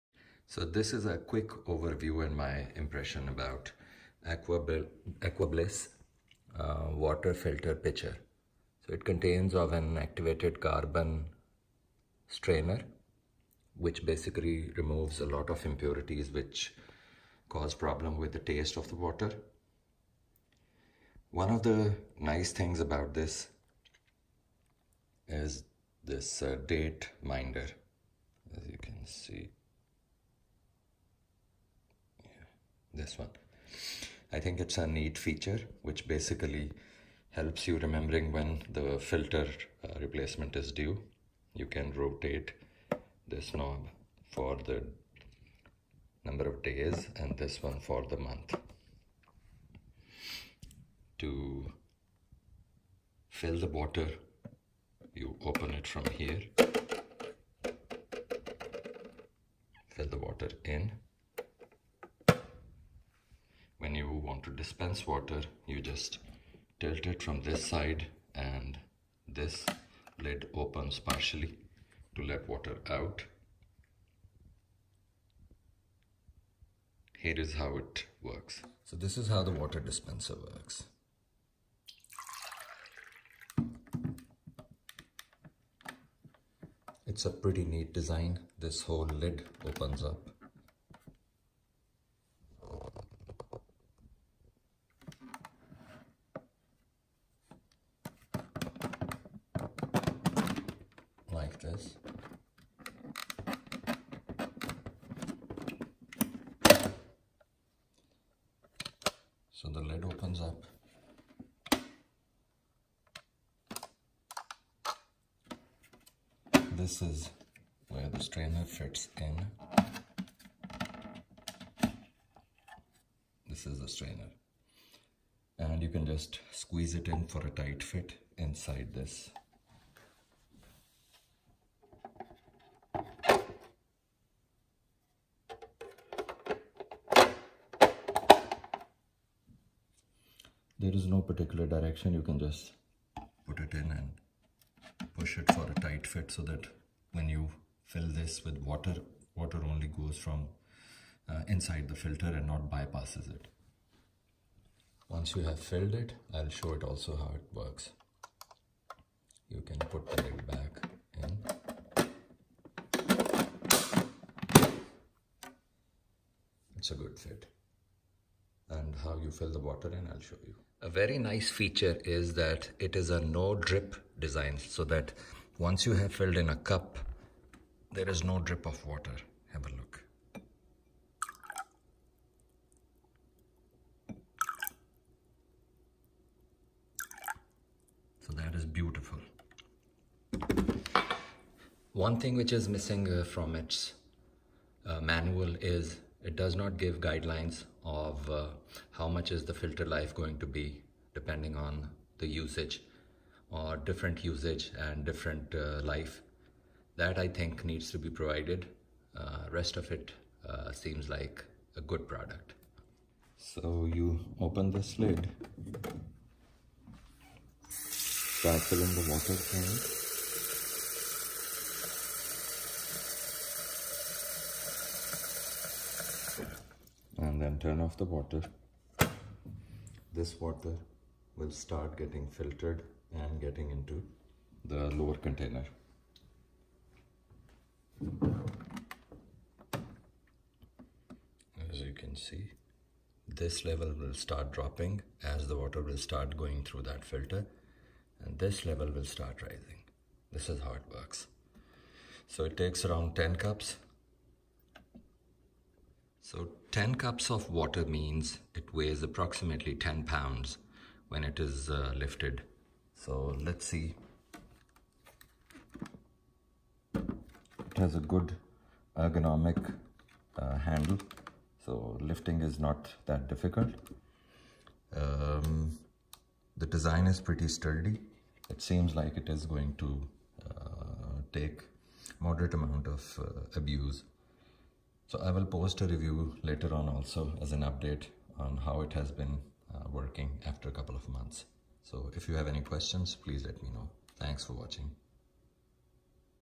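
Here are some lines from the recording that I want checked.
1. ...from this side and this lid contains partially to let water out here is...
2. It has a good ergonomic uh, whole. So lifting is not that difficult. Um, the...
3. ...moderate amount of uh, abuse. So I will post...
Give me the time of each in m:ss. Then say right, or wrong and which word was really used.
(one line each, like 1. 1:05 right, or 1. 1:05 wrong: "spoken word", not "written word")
1. 1:07 wrong: "opens", not "contains"
2. 4:26 wrong: "handle", not "whole"
3. 4:42 right.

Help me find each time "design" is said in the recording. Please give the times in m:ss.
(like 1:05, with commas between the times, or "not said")
1:28, 2:54, 4:36.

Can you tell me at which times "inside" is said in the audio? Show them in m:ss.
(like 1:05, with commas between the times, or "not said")
2:08, 2:31.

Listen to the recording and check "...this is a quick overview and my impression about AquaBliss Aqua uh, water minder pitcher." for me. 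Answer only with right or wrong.
wrong.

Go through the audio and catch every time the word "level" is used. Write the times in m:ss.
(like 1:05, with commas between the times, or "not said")
4:03, 4:08.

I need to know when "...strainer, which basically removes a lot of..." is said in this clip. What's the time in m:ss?
0:12.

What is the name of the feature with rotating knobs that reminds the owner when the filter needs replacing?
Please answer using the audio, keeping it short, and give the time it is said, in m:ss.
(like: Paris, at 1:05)
date minder, at 0:26.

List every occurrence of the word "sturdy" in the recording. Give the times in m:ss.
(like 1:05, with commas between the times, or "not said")
4:37.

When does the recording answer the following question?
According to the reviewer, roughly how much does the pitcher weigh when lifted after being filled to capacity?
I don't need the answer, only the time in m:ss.
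4:19.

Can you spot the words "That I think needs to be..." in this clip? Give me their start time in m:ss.
3:26.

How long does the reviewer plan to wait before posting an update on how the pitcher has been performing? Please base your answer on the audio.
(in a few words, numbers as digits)
a couple of months.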